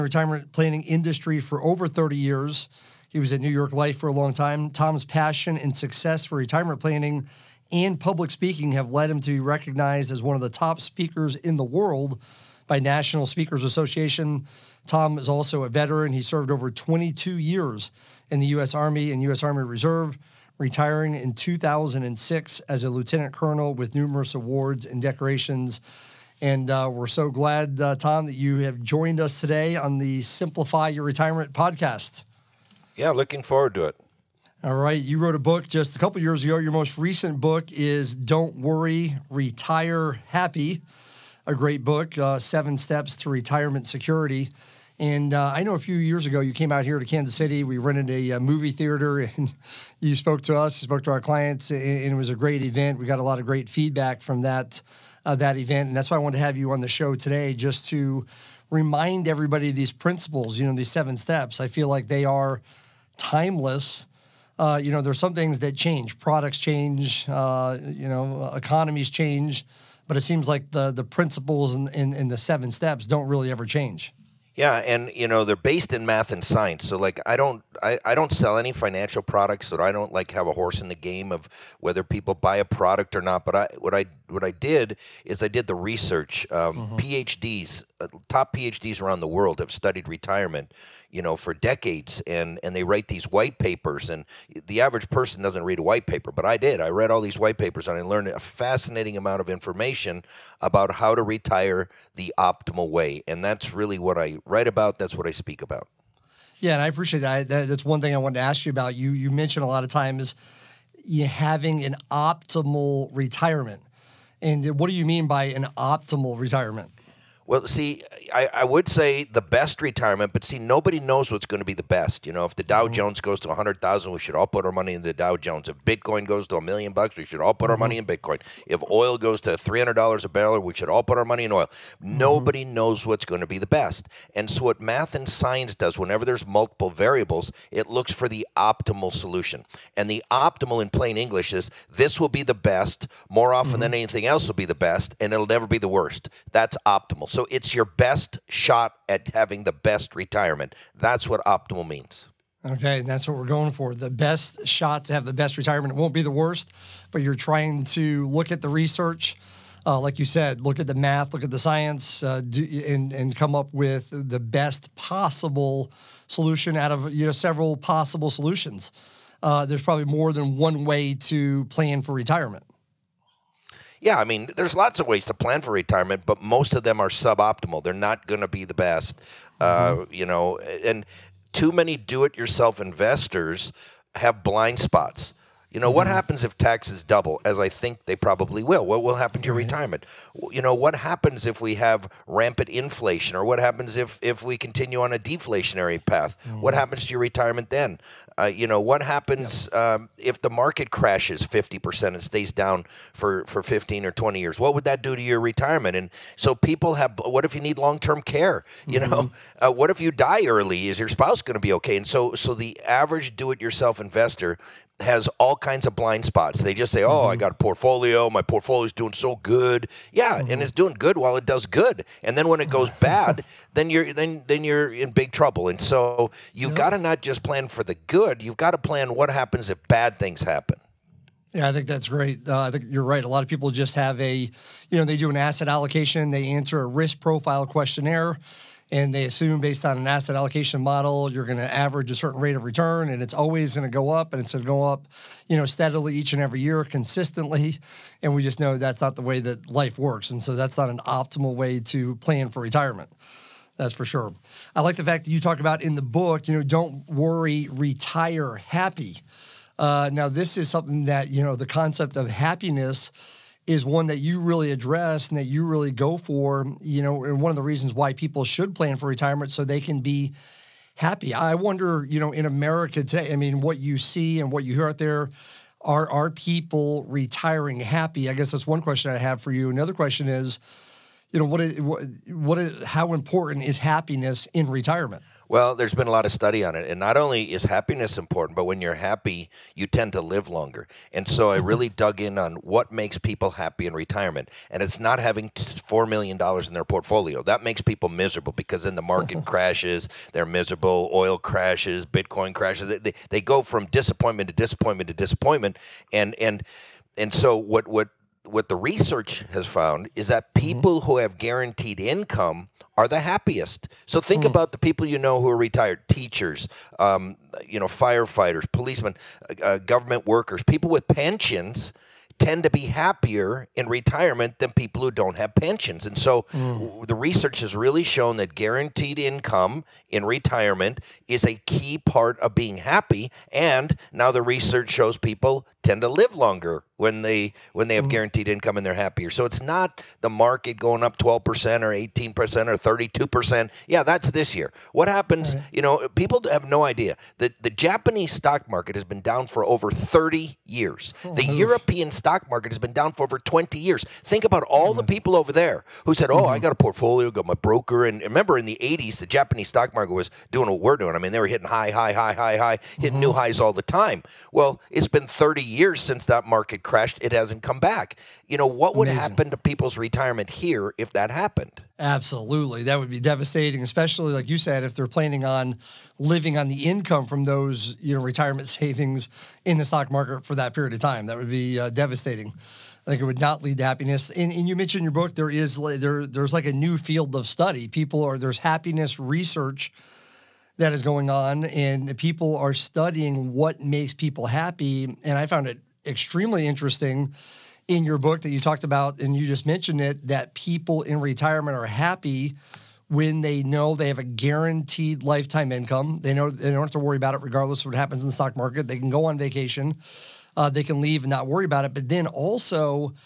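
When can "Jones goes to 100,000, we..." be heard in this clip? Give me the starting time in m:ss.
2:02.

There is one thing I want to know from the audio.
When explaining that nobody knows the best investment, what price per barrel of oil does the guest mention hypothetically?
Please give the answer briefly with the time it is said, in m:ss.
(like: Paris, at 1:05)
$300, at 2:09.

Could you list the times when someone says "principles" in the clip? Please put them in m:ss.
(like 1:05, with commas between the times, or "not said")
0:59, 1:11.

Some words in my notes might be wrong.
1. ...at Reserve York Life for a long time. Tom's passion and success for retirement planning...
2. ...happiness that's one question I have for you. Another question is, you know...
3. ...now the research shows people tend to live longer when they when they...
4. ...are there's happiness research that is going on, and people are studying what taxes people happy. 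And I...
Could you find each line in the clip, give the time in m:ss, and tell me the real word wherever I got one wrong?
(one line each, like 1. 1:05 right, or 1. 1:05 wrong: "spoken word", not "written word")
1. 0:03 wrong: "New", not "Reserve"
2. 4:38 wrong: "guess", not "happiness"
3. 5:34 right
4. 6:28 wrong: "makes", not "taxes".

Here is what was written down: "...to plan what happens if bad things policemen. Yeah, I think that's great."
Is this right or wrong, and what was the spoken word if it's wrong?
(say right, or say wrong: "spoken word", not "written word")
wrong: "happen", not "policemen".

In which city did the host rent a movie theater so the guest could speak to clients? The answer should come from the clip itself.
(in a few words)
Kansas City.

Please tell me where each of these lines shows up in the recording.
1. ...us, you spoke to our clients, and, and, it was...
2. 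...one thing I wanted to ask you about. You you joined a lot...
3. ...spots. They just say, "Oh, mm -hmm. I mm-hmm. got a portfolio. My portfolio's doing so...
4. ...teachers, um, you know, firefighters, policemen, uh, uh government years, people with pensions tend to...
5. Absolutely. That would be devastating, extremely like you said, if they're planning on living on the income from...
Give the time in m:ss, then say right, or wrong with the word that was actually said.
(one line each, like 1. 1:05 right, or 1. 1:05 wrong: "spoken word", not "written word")
1. 0:50 right
2. 1:47 wrong: "mentioned", not "joined"
3. 3:36 right
4. 5:16 wrong: "workers", not "years"
5. 6:11 wrong: "especially", not "extremely".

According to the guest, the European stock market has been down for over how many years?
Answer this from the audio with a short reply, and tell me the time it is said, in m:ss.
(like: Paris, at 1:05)
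20 years, at 5:53.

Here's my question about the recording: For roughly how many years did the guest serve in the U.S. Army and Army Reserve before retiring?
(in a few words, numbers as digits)
22 years.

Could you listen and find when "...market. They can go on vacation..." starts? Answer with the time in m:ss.
6:48.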